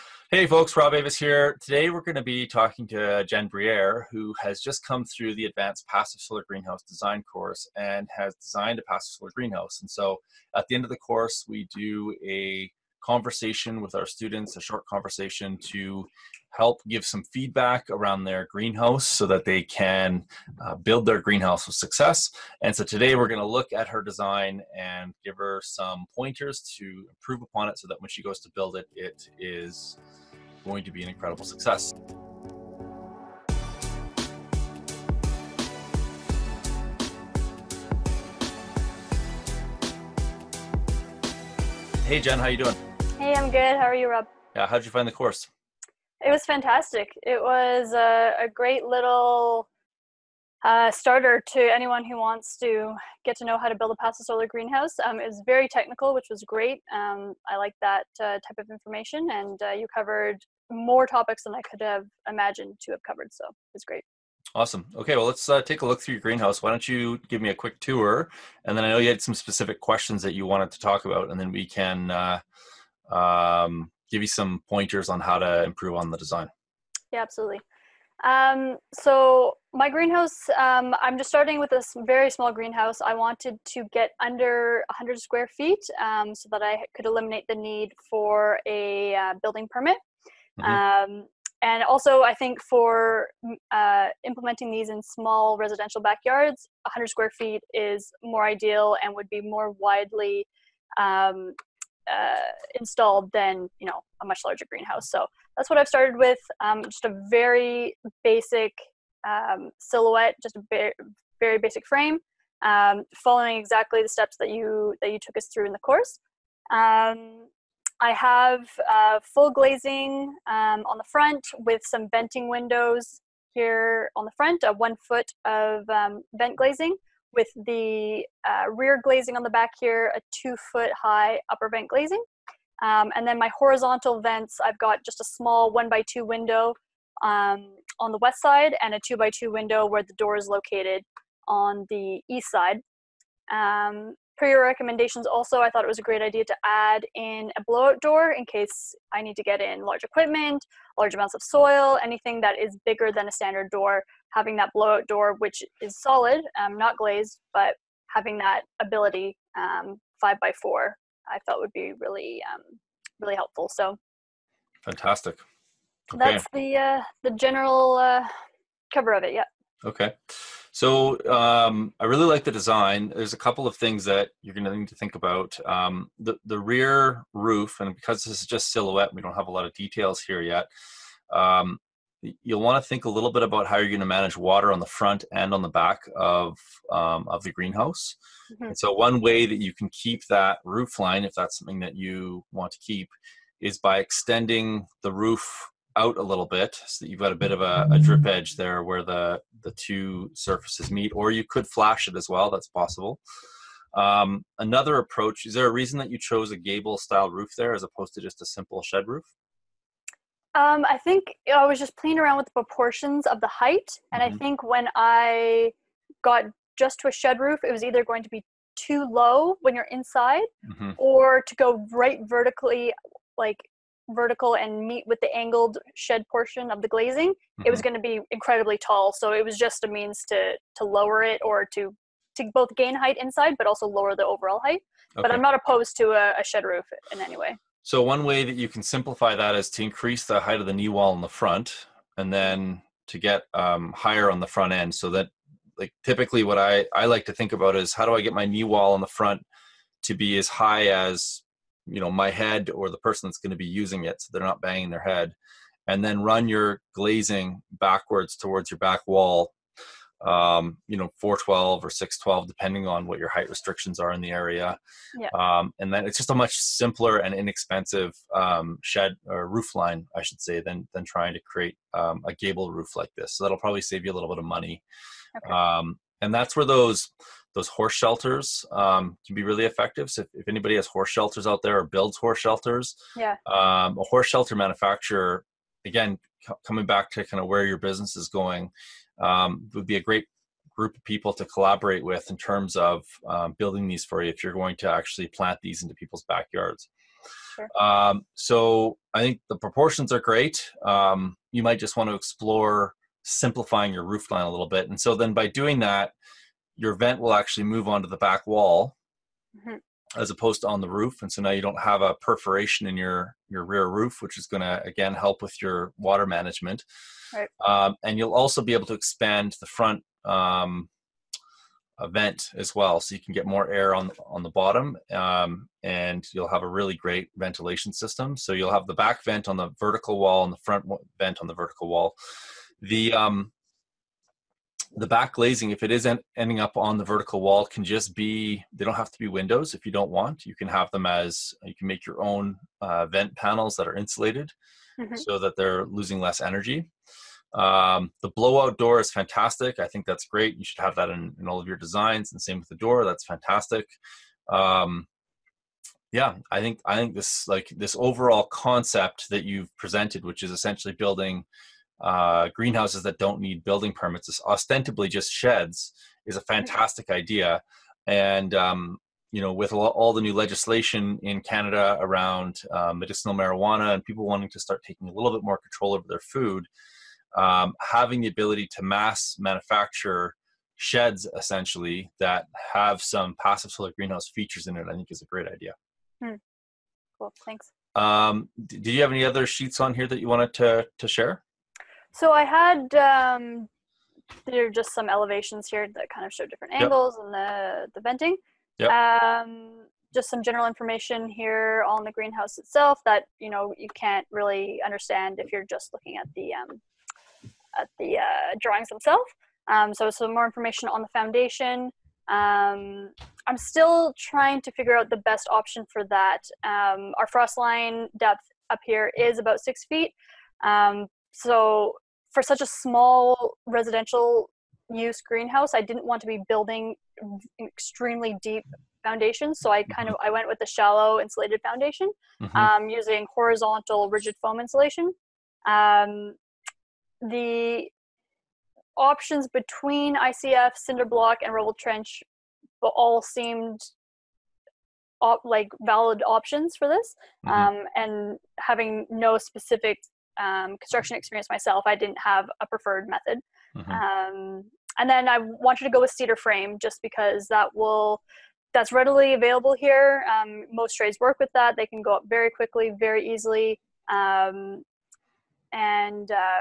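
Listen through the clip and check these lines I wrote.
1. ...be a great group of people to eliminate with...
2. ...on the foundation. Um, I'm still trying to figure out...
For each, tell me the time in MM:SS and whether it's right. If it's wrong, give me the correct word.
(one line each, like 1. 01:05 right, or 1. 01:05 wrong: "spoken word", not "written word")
1. 04:49 wrong: "collaborate", not "eliminate"
2. 06:50 right.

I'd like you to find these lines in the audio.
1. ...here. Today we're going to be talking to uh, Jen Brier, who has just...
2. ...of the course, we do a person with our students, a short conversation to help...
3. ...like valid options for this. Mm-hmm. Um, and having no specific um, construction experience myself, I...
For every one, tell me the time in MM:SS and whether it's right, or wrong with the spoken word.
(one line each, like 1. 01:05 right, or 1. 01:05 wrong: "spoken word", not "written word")
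1. 00:01 right
2. 00:10 wrong: "conversation", not "person"
3. 07:25 right.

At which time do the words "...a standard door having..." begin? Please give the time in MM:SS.
02:33.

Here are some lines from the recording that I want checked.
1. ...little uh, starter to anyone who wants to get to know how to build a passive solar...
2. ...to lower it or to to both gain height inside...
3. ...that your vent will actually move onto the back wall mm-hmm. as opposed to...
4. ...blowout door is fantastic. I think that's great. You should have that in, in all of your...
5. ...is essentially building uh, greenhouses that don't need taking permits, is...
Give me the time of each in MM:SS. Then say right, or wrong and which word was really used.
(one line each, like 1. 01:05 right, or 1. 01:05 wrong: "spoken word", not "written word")
1. 00:48 right
2. 03:50 right
3. 05:05 right
4. 05:48 right
5. 06:00 wrong: "building", not "taking".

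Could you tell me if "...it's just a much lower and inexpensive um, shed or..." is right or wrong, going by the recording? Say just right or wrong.
wrong.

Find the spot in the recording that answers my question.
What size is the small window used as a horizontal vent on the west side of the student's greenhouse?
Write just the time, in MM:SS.
02:15.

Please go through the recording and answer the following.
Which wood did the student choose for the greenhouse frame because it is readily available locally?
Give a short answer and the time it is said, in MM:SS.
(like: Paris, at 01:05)
cedar, at 07:36.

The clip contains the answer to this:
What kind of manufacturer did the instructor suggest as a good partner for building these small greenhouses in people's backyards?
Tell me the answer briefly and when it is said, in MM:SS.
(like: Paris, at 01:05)
horse shelter manufacturer, at 04:44.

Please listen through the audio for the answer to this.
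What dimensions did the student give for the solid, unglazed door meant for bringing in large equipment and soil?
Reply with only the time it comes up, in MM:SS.
02:40.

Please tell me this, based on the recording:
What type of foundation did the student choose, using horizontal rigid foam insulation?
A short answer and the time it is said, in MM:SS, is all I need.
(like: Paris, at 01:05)
shallow insulated foundation, at 07:10.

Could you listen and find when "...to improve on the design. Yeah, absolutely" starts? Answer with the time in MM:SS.
01:15.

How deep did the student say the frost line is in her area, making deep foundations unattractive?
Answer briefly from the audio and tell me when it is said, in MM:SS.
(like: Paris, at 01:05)
6 feet, at 06:59.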